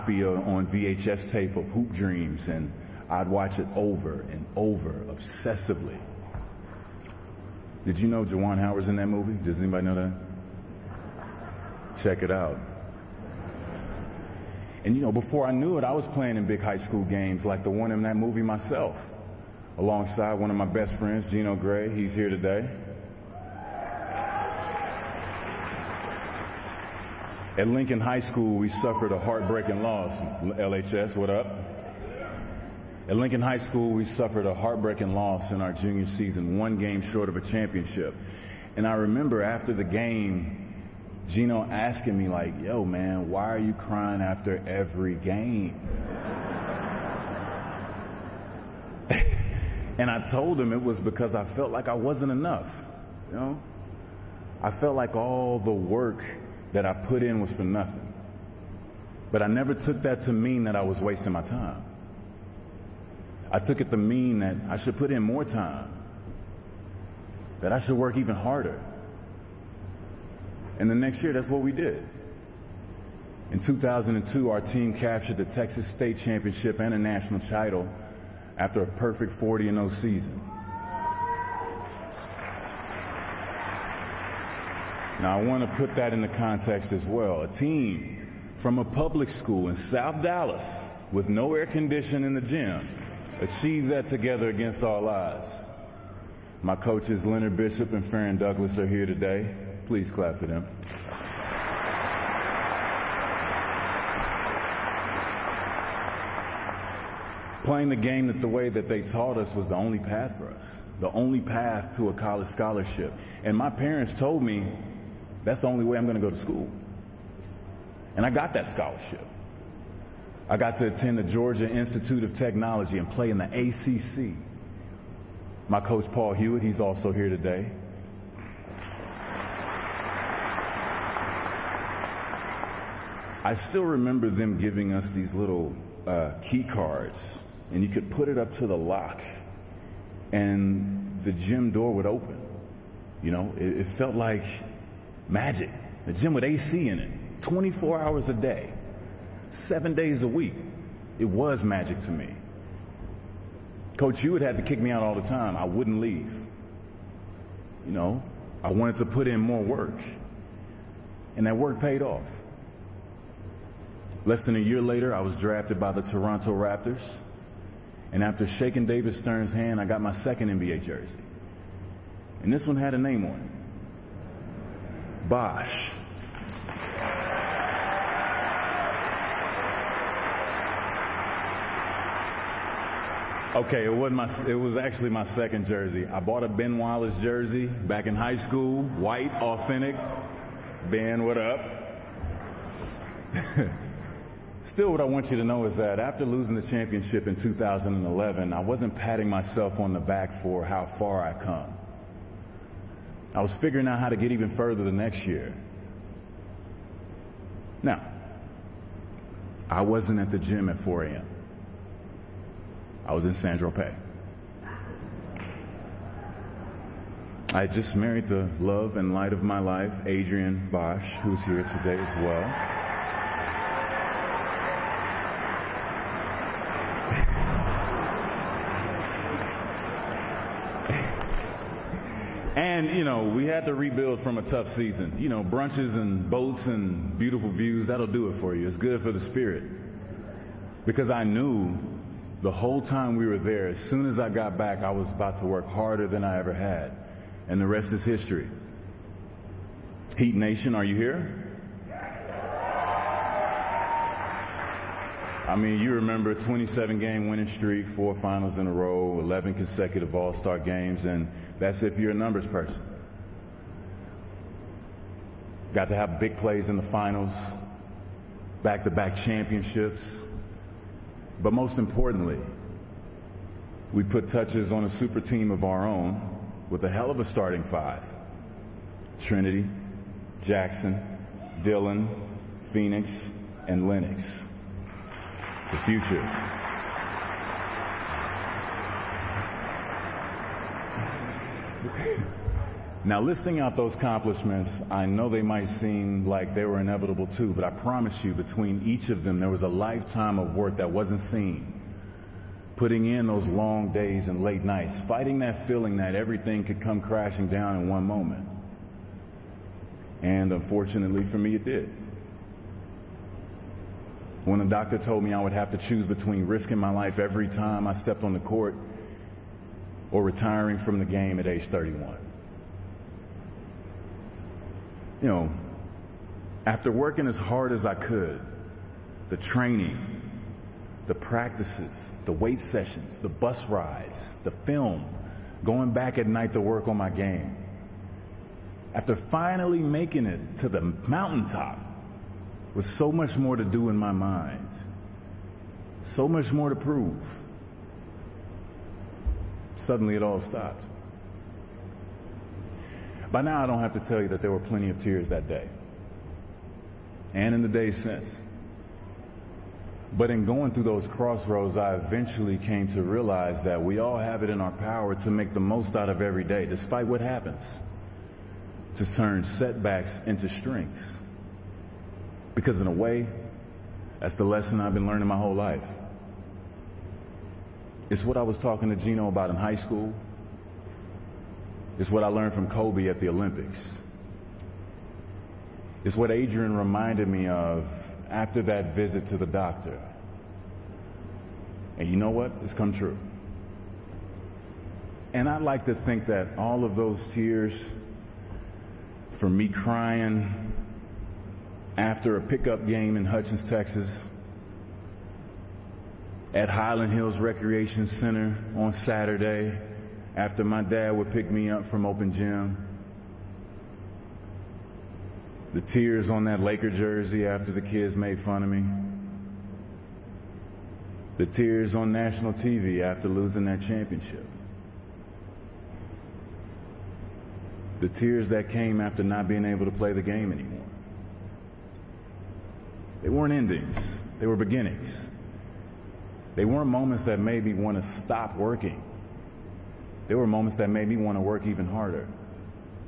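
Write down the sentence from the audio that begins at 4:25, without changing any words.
Got to have big plays in the finals, back to back championships.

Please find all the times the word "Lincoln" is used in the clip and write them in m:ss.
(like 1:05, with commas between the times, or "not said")
0:27, 0:33.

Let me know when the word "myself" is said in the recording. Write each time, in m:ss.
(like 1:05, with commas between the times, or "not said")
0:18, 3:19.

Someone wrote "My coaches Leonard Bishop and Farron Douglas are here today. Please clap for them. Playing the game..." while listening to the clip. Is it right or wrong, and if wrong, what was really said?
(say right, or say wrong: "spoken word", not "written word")
right.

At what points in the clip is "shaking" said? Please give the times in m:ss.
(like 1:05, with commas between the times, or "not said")
2:48.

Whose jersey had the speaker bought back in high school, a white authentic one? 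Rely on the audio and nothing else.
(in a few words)
Ben Wallace.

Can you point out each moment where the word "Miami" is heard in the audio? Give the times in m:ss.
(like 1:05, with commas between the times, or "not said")
not said.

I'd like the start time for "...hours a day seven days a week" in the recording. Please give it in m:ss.
2:28.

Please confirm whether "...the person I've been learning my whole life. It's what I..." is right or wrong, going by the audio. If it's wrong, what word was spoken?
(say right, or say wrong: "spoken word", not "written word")
wrong: "lesson", not "person".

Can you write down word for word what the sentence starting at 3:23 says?
I was figuring out how to get even further the next year.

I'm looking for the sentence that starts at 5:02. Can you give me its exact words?
Putting in those long days and late nights, fighting that feeling that everything could come crashing down in one moment.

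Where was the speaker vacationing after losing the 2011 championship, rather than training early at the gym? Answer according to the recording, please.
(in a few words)
Saint-Tropez.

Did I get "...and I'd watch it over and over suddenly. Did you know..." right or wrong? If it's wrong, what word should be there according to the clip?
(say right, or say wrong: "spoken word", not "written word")
wrong: "obsessively", not "suddenly".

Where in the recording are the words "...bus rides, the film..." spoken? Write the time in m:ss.
5:33.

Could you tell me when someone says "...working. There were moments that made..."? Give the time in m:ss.
7:18.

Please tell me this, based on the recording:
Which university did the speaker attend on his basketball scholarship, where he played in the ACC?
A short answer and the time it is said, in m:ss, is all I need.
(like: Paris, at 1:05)
Georgia Institute of Technology, at 2:01.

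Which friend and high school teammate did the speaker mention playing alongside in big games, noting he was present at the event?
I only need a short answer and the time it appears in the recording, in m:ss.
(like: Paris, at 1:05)
Gino Gray, at 0:21.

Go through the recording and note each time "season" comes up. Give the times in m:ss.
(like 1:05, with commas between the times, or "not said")
0:36, 1:20, 3:54.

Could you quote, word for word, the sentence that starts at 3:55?
You know, brunches and boats and beautiful views, that'll do it for you.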